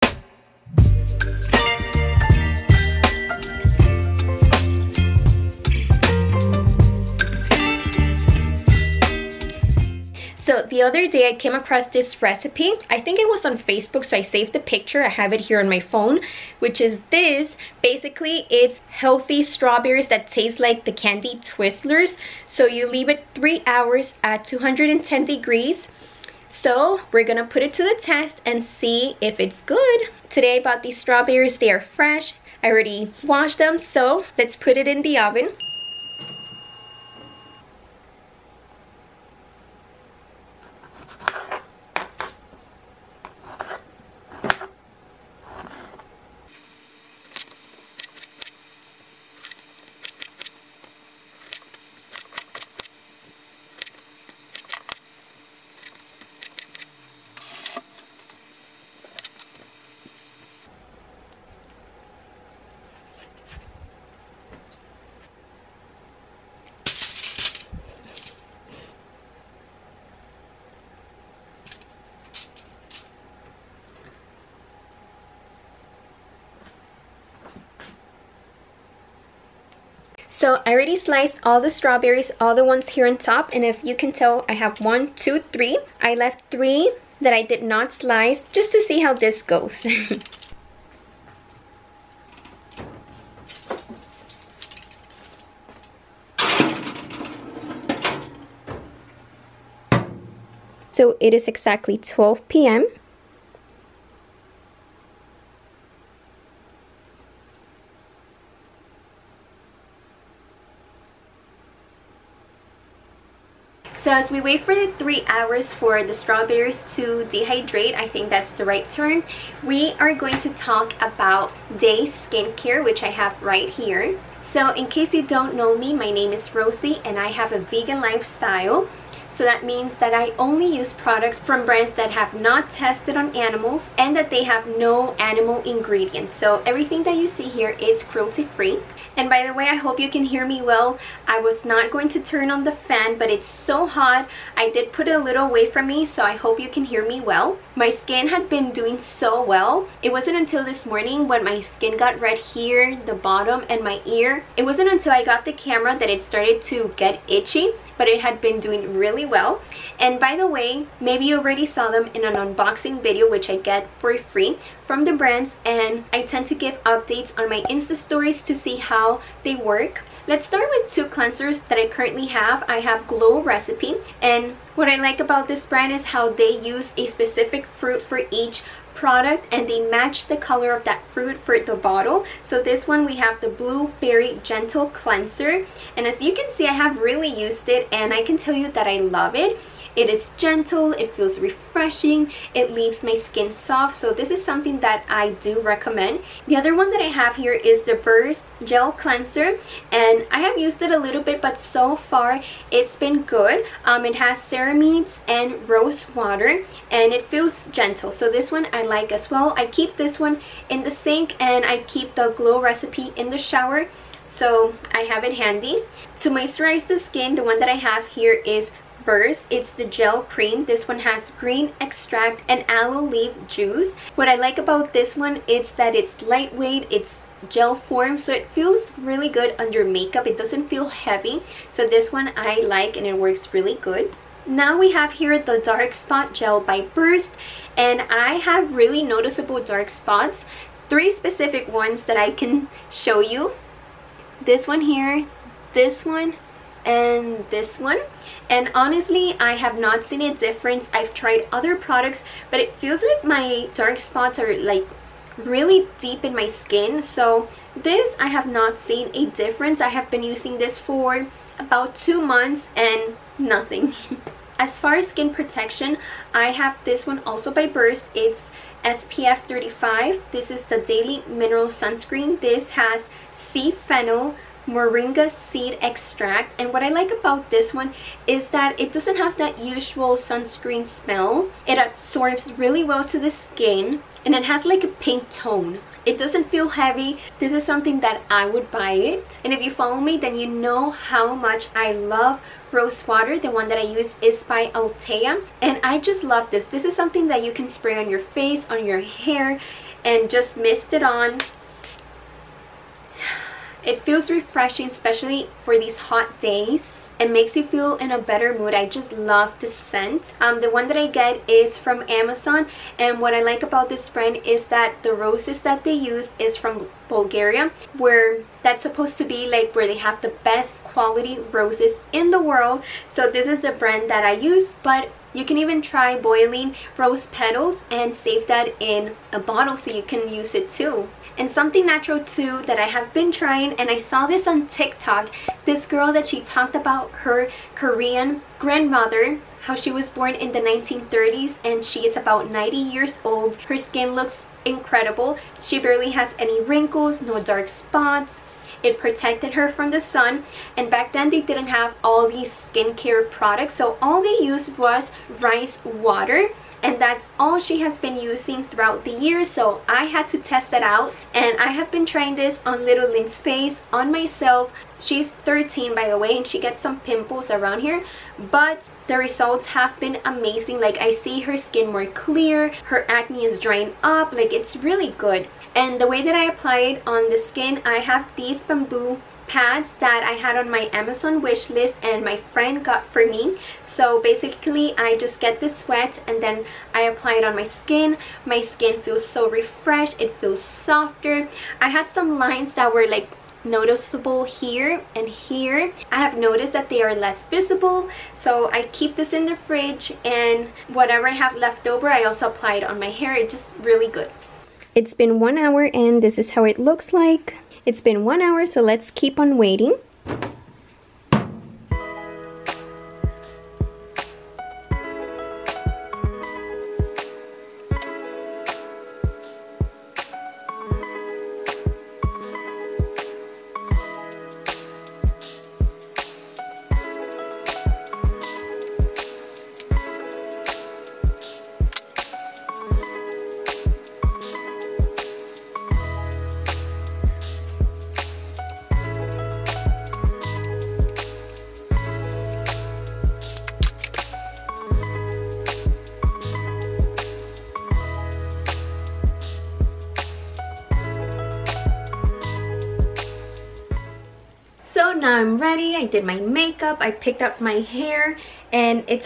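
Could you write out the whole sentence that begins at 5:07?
It makes you feel in a better mood.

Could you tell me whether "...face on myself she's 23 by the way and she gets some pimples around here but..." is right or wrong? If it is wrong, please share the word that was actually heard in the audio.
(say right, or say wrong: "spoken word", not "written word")
wrong: "13", not "23".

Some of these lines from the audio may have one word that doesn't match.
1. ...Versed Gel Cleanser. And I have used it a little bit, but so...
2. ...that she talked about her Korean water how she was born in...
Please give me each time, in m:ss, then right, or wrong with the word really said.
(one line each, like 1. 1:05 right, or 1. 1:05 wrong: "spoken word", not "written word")
1. 3:17 right
2. 5:36 wrong: "grandmother", not "water".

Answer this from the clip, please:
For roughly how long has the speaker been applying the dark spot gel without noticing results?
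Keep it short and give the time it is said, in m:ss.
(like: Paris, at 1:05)
2 months, at 4:21.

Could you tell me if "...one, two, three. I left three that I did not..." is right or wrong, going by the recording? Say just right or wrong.
right.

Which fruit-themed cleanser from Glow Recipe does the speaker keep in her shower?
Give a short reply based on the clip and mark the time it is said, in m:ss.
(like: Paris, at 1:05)
Blueberry Gentle Cleanser, at 3:03.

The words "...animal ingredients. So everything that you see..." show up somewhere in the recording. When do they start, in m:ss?
2:15.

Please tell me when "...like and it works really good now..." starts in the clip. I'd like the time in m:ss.
3:52.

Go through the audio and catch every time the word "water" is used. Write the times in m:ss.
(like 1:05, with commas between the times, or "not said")
3:26, 4:53, 5:55.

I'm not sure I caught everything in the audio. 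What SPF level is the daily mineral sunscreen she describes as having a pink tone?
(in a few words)
35.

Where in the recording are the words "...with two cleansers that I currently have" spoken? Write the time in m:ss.
2:50.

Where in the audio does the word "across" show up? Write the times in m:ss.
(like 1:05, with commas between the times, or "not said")
0:11.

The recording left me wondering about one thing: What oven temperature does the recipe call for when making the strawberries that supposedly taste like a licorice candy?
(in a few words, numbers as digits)
210 degrees.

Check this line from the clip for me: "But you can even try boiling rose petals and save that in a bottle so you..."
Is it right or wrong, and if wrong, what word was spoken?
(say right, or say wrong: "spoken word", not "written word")
right.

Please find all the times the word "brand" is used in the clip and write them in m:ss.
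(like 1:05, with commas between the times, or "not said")
2:11, 2:45, 2:55, 5:14, 5:23.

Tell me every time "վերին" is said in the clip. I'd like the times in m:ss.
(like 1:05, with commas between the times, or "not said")
not said.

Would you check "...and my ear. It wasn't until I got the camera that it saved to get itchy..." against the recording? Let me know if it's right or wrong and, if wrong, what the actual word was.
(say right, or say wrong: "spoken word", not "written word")
wrong: "started", not "saved".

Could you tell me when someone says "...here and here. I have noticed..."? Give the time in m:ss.
6:34.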